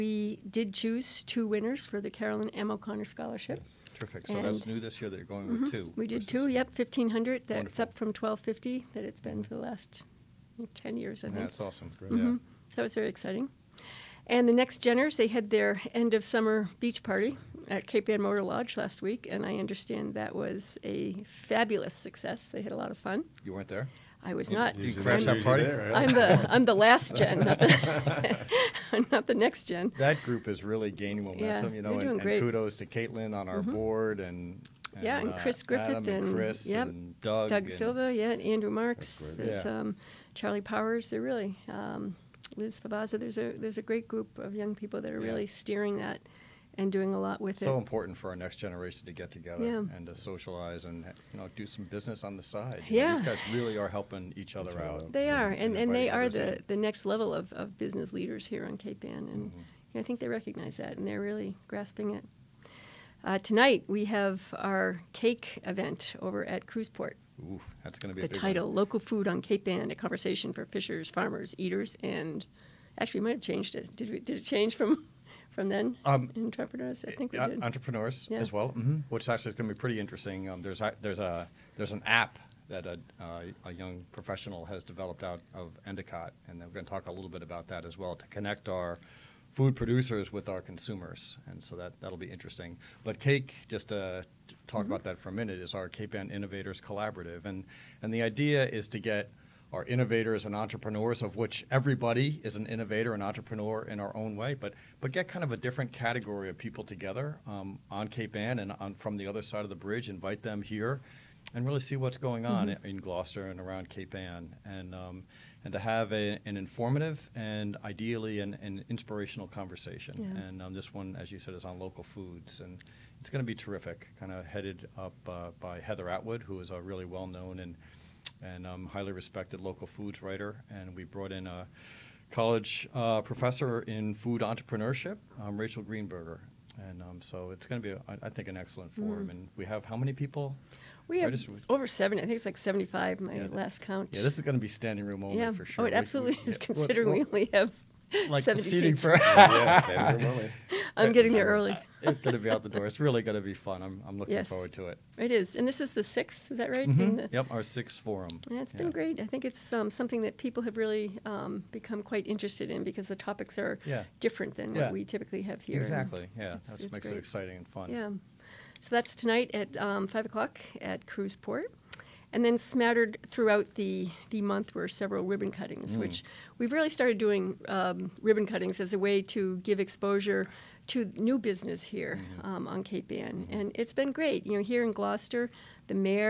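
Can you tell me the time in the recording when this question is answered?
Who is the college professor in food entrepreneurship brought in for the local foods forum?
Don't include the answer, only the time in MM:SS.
02:15.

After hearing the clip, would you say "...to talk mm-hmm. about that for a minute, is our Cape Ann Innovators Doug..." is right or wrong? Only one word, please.
wrong.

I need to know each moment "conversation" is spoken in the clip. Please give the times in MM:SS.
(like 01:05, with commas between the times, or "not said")
01:09, 01:59.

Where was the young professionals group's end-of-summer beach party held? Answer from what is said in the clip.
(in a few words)
Cape Ann Motor Lodge.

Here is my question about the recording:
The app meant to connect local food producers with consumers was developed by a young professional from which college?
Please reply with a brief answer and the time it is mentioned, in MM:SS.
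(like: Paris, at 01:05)
Endicott, at 01:25.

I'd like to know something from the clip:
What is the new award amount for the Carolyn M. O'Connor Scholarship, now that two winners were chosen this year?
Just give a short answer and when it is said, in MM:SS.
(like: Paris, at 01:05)
$1,500, at 00:06.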